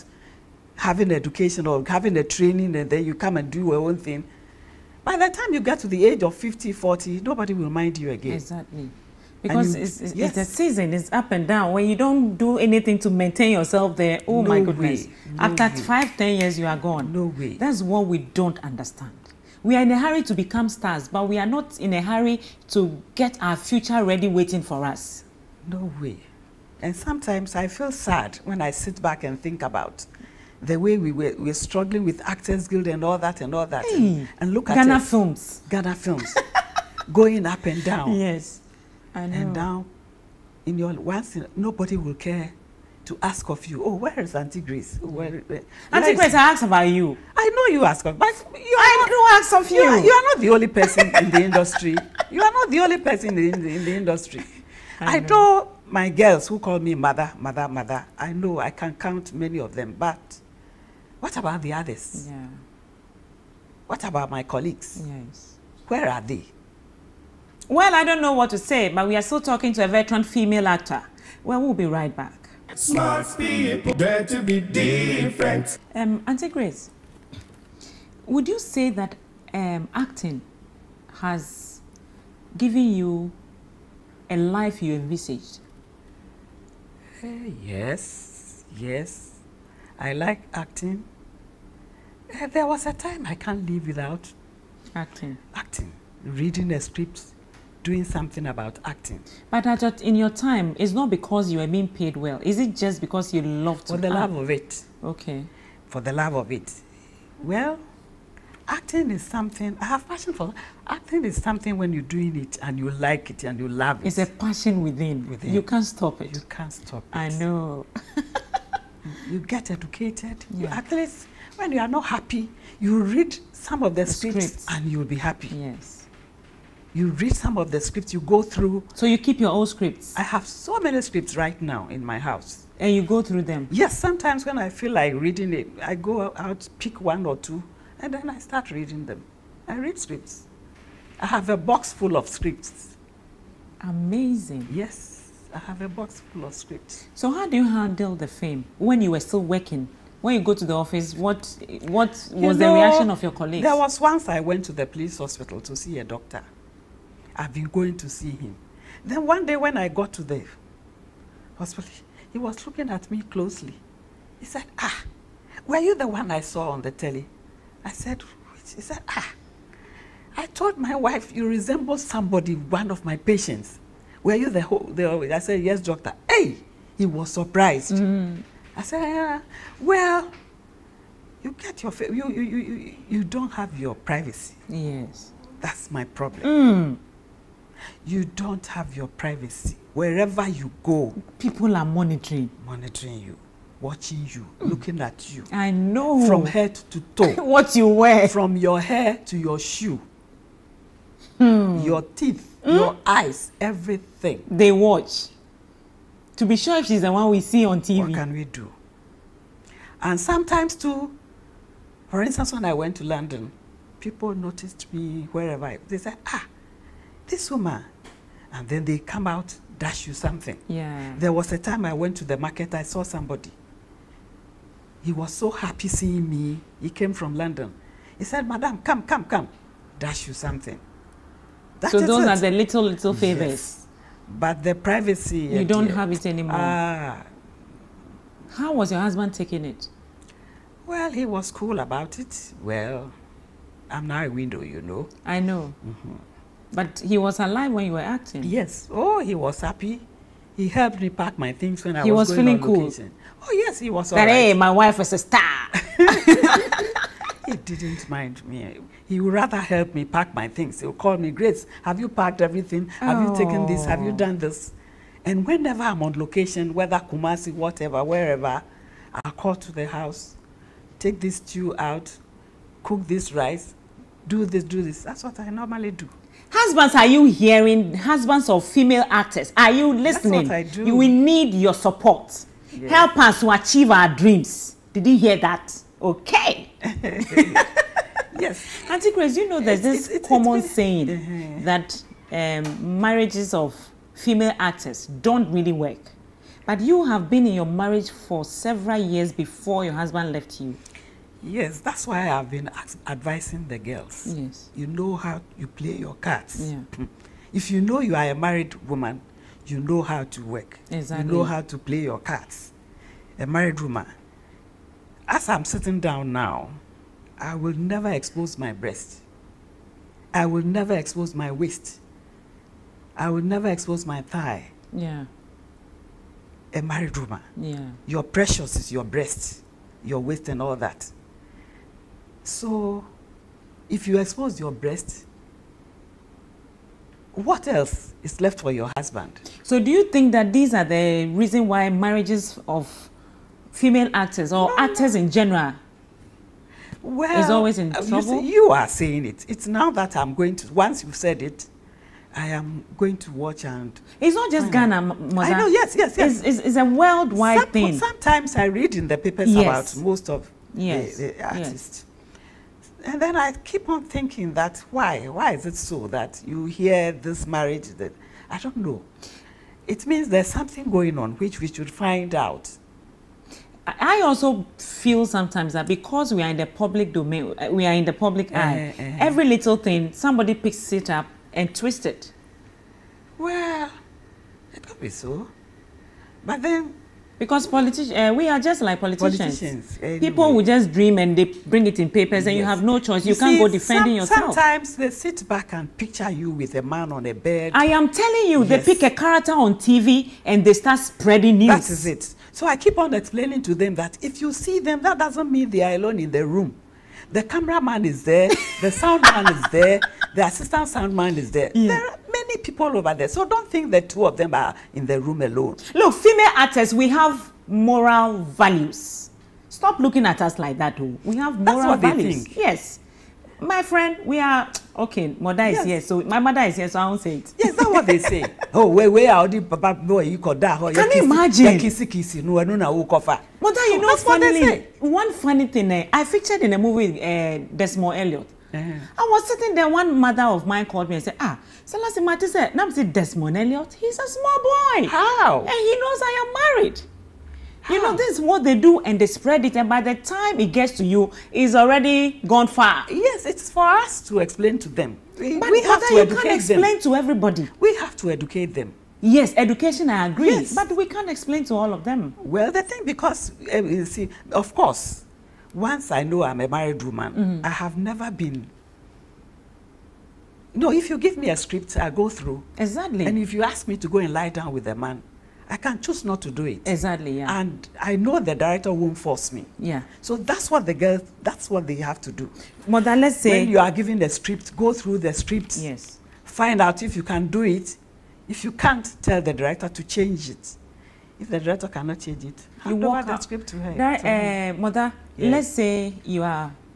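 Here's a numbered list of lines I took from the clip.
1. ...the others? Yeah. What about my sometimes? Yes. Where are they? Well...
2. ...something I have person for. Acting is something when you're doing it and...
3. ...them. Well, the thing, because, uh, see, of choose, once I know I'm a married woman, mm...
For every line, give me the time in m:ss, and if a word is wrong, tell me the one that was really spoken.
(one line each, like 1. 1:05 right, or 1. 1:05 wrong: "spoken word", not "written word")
1. 1:01 wrong: "colleagues", not "sometimes"
2. 1:49 wrong: "passion", not "person"
3. 7:42 wrong: "course", not "choose".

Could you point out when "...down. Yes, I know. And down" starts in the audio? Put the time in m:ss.
0:37.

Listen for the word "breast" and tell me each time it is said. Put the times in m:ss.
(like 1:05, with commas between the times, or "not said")
5:18, 5:29, 5:34.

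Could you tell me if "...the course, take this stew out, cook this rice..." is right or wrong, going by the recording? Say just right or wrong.
wrong.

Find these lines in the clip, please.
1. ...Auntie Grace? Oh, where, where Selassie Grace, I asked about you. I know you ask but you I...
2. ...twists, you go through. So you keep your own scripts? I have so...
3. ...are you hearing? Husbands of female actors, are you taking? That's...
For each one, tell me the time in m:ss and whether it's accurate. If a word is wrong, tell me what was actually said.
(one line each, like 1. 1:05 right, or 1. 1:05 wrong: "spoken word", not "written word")
1. 0:44 wrong: "Auntie", not "Selassie"
2. 2:07 wrong: "scripts", not "twists"
3. 4:36 wrong: "listening", not "taking".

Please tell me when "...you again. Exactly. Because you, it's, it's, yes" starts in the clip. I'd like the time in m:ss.
0:07.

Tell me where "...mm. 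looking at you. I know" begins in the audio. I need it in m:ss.
3:14.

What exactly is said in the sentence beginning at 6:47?
The cameraman is there, the sound man is there, the assistant sound man is there.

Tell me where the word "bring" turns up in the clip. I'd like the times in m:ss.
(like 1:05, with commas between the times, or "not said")
6:31.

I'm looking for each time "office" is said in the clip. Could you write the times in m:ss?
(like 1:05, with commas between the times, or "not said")
2:30.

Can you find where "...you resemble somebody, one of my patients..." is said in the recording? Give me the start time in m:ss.
2:51.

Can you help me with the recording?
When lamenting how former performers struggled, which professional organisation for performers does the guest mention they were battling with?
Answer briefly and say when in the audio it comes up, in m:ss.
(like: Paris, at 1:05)
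Actors Guild, at 0:32.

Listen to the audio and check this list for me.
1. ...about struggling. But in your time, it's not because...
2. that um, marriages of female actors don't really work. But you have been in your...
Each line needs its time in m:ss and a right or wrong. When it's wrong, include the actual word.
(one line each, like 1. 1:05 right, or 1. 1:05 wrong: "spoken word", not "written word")
1. 1:38 wrong: "acting", not "struggling"
2. 4:51 right.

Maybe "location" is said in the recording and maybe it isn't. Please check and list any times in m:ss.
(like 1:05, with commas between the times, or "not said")
4:12, 4:26.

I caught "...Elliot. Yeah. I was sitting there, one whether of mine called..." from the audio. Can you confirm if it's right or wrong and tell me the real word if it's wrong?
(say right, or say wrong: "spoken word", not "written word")
wrong: "mother", not "whether".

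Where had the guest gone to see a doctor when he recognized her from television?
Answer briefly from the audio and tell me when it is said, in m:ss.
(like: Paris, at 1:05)
The police hospital, at 2:34.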